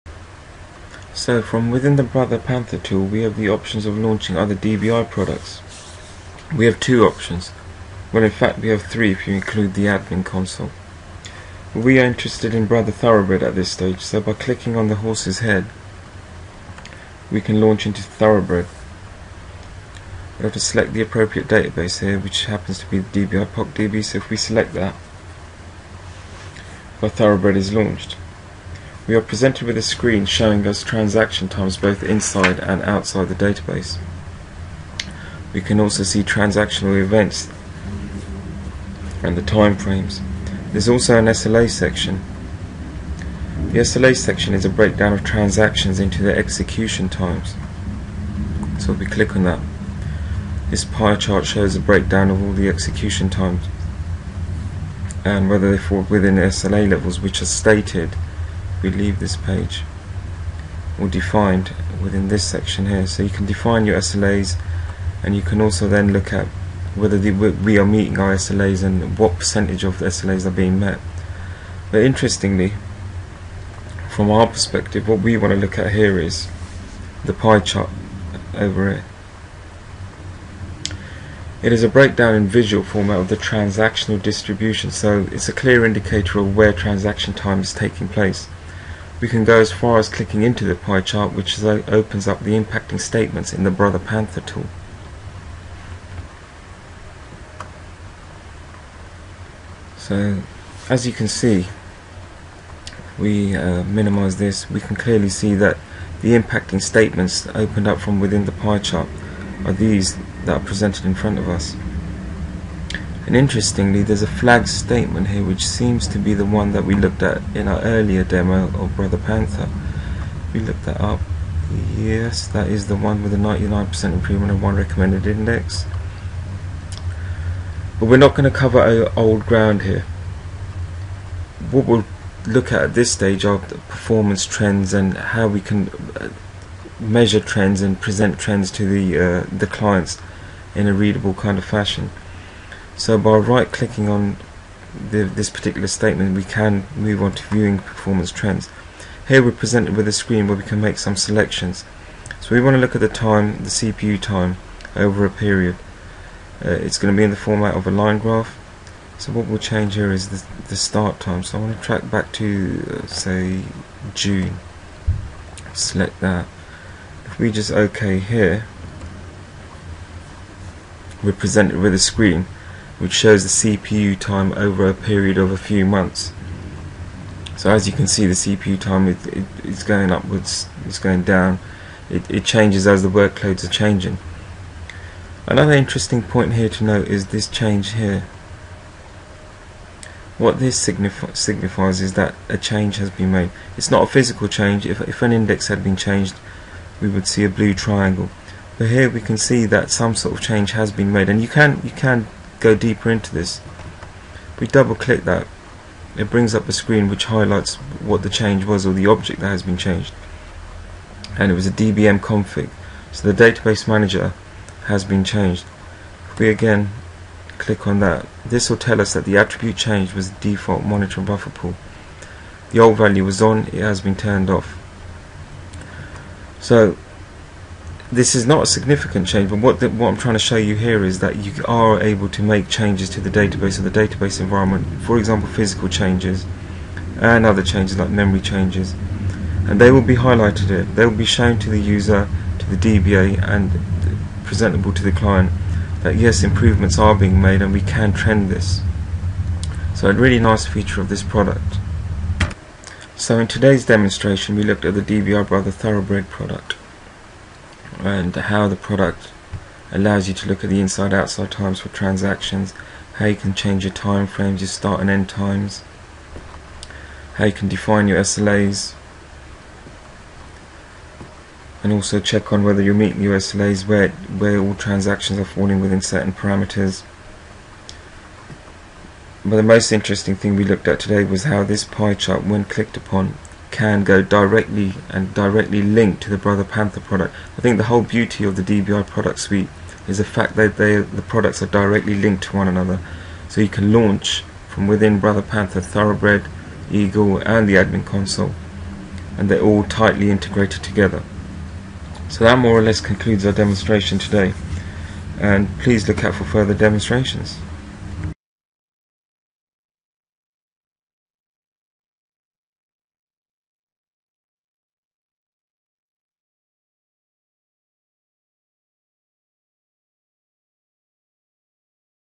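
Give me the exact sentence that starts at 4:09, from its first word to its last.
So a really nice feature of this product.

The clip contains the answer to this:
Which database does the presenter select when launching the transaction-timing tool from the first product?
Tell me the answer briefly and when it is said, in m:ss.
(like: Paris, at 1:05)
DBI POC DB, at 0:23.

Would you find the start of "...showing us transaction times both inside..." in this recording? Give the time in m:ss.
0:30.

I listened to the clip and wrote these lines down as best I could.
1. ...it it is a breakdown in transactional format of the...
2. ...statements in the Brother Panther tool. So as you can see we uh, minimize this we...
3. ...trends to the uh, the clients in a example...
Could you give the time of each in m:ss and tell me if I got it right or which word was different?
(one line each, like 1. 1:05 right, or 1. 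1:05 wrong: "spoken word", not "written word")
1. 1:18 wrong: "visual", not "transactional"
2. 1:32 right
3. 2:18 wrong: "readable", not "example".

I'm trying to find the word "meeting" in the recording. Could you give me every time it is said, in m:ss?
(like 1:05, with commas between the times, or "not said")
1:07, 4:32.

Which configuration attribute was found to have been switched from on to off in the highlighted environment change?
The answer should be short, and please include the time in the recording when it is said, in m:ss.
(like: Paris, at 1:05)
Default monitor buffer pool, at 3:40.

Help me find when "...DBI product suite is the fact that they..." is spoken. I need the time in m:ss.
4:48.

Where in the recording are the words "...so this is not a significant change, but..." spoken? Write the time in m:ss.
3:46.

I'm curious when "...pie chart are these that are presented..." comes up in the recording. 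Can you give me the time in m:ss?
1:48.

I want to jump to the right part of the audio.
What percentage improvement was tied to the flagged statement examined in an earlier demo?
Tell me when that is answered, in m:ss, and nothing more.
2:03.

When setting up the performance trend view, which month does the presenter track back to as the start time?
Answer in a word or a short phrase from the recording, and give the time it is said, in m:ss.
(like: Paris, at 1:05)
June, at 2:44.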